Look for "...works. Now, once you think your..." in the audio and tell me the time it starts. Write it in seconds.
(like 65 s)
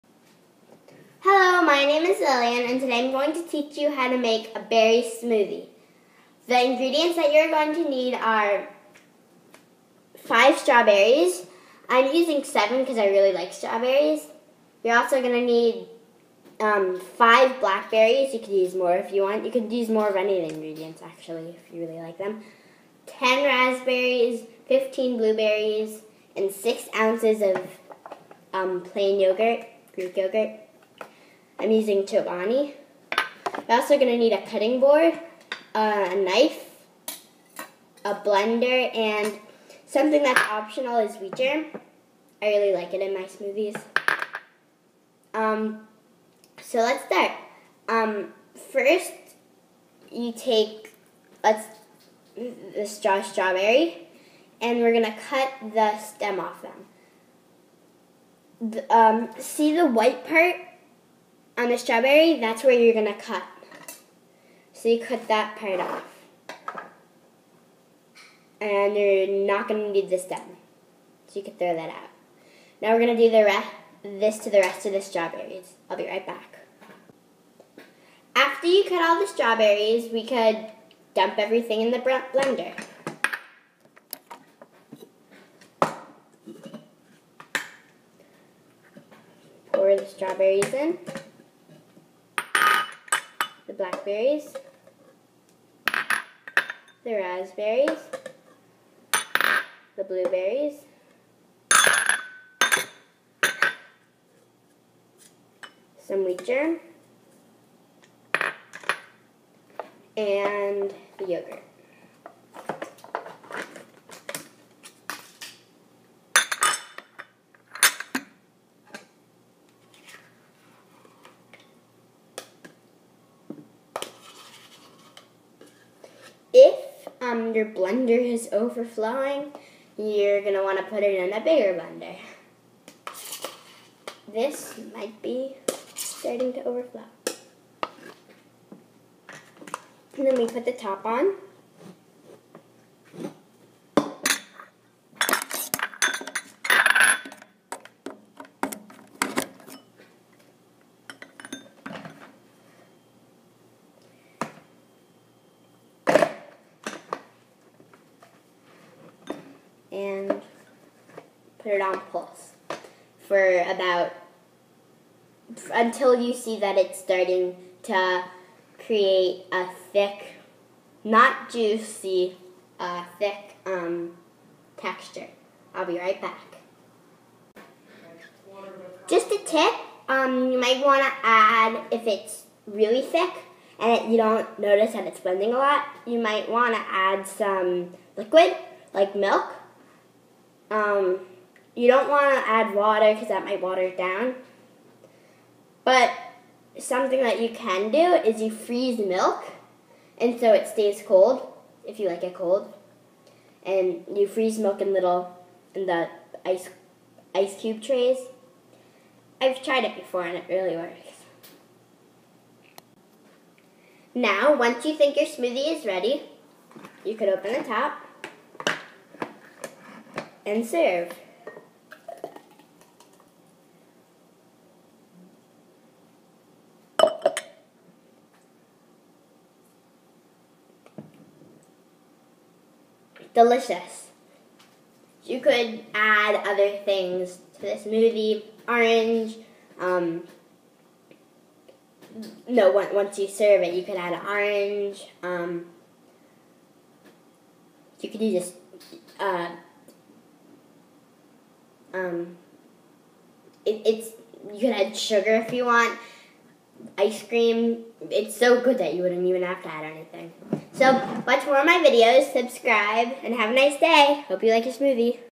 210 s.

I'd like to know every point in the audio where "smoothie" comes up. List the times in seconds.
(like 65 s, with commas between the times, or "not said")
5 s, 43 s, 215 s, 237 s, 264 s.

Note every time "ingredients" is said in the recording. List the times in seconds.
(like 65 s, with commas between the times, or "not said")
6 s, 20 s.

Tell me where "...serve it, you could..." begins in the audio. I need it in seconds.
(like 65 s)
243 s.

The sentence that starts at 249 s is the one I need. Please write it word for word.
uh, um, it, it's you can add sugar if you want.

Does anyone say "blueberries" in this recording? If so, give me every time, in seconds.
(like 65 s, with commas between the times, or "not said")
25 s, 100 s.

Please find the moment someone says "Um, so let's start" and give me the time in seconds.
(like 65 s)
45 s.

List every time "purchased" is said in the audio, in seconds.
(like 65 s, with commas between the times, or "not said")
not said.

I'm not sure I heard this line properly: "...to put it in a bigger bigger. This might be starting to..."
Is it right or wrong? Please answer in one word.
wrong.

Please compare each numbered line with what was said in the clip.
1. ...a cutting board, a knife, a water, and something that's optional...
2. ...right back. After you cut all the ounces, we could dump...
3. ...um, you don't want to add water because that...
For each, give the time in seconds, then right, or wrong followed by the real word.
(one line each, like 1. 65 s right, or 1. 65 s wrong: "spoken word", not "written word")
1. 34 s wrong: "blender", not "water"
2. 76 s wrong: "strawberries", not "ounces"
3. 190 s right.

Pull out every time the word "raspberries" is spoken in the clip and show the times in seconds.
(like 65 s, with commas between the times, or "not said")
23 s, 97 s.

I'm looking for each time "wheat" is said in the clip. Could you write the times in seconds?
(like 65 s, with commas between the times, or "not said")
41 s, 106 s.